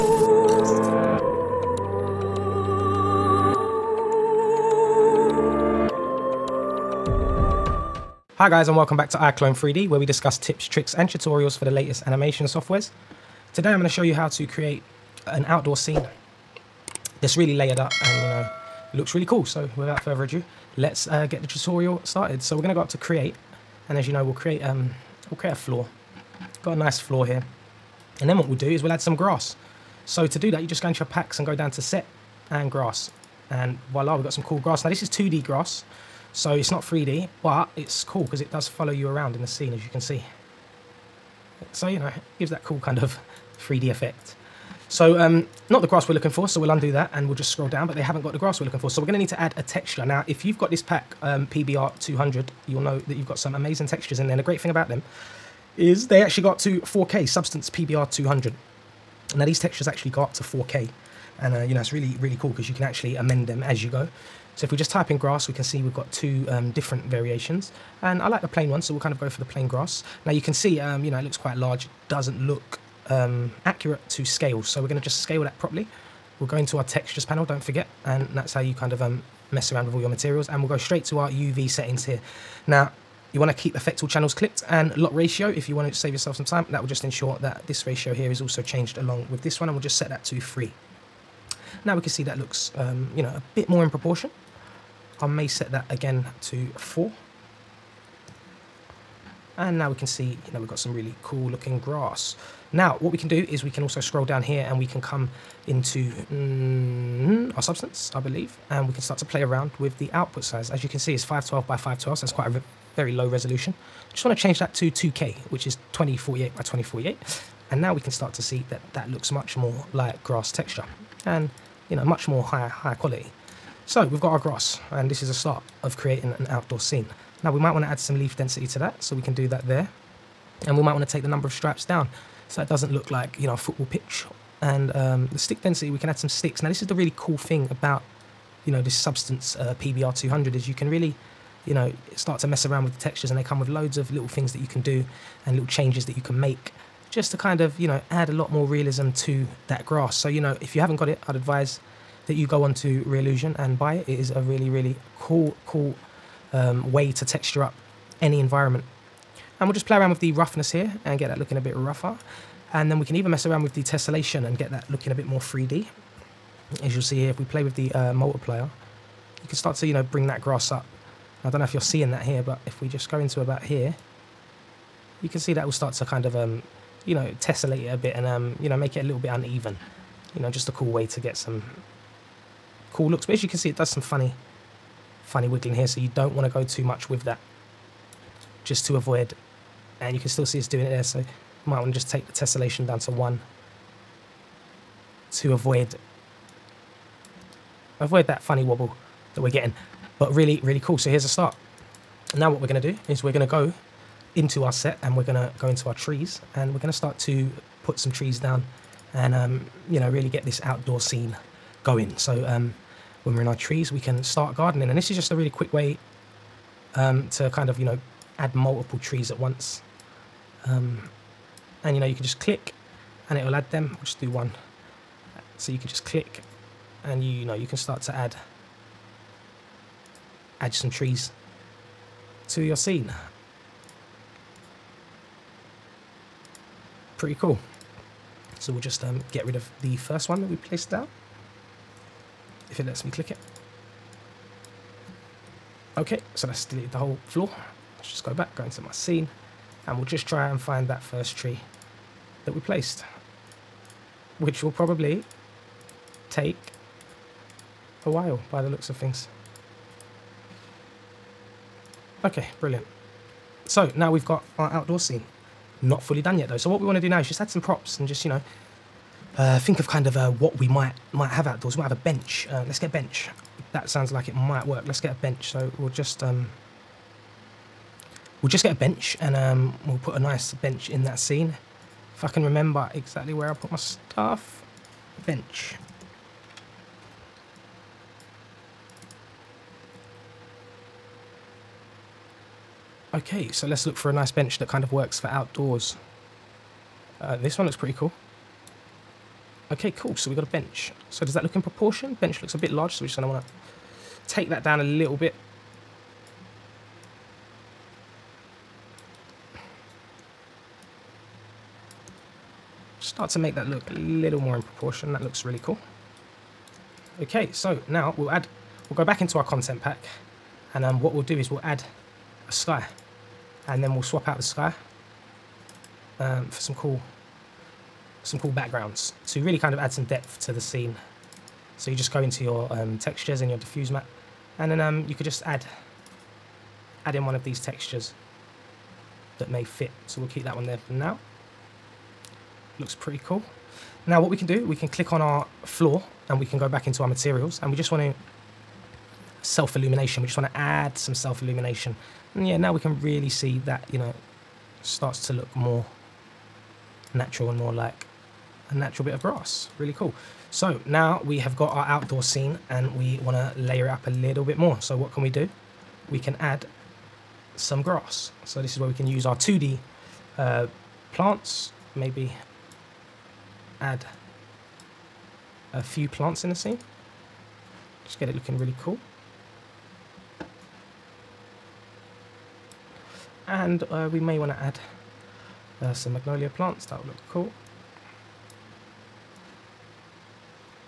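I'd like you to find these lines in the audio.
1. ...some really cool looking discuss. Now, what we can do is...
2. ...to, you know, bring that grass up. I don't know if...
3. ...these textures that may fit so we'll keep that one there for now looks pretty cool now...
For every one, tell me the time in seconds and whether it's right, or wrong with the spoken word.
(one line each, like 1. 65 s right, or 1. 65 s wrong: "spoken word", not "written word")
1. 100 s wrong: "grass", not "discuss"
2. 169 s right
3. 337 s right.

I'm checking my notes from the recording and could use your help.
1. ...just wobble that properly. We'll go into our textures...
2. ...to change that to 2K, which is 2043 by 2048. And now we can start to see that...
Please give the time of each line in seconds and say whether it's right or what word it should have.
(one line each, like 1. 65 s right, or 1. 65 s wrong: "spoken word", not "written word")
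1. 74 s wrong: "scale", not "wobble"
2. 114 s wrong: "2048", not "2043".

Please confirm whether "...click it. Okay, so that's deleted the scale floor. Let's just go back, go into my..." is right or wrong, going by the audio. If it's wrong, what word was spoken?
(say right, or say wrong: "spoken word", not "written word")
wrong: "whole", not "scale".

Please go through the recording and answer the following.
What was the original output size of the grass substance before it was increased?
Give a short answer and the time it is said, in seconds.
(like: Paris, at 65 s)
512 by 512, at 111 s.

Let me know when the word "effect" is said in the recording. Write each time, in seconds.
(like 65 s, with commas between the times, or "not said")
43 s, 83 s.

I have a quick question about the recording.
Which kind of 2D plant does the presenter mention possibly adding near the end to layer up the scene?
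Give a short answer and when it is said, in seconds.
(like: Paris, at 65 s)
Magnolia, at 386 s.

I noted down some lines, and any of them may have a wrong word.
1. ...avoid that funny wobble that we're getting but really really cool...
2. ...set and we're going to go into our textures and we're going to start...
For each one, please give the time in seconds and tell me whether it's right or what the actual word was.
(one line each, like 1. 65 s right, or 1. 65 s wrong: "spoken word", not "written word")
1. 197 s right
2. 204 s wrong: "trees", not "textures".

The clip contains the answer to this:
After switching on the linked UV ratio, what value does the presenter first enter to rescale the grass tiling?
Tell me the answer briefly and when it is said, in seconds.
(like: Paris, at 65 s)
3, at 89 s.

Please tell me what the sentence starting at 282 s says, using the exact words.
If I can remember exactly where I put my stuff, bench.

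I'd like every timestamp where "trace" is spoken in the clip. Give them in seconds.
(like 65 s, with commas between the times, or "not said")
not said.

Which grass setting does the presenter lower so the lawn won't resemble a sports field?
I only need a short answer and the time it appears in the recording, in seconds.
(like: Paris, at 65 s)
number of stripes, at 131 s.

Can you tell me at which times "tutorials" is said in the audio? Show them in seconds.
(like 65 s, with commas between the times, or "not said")
11 s, 21 s.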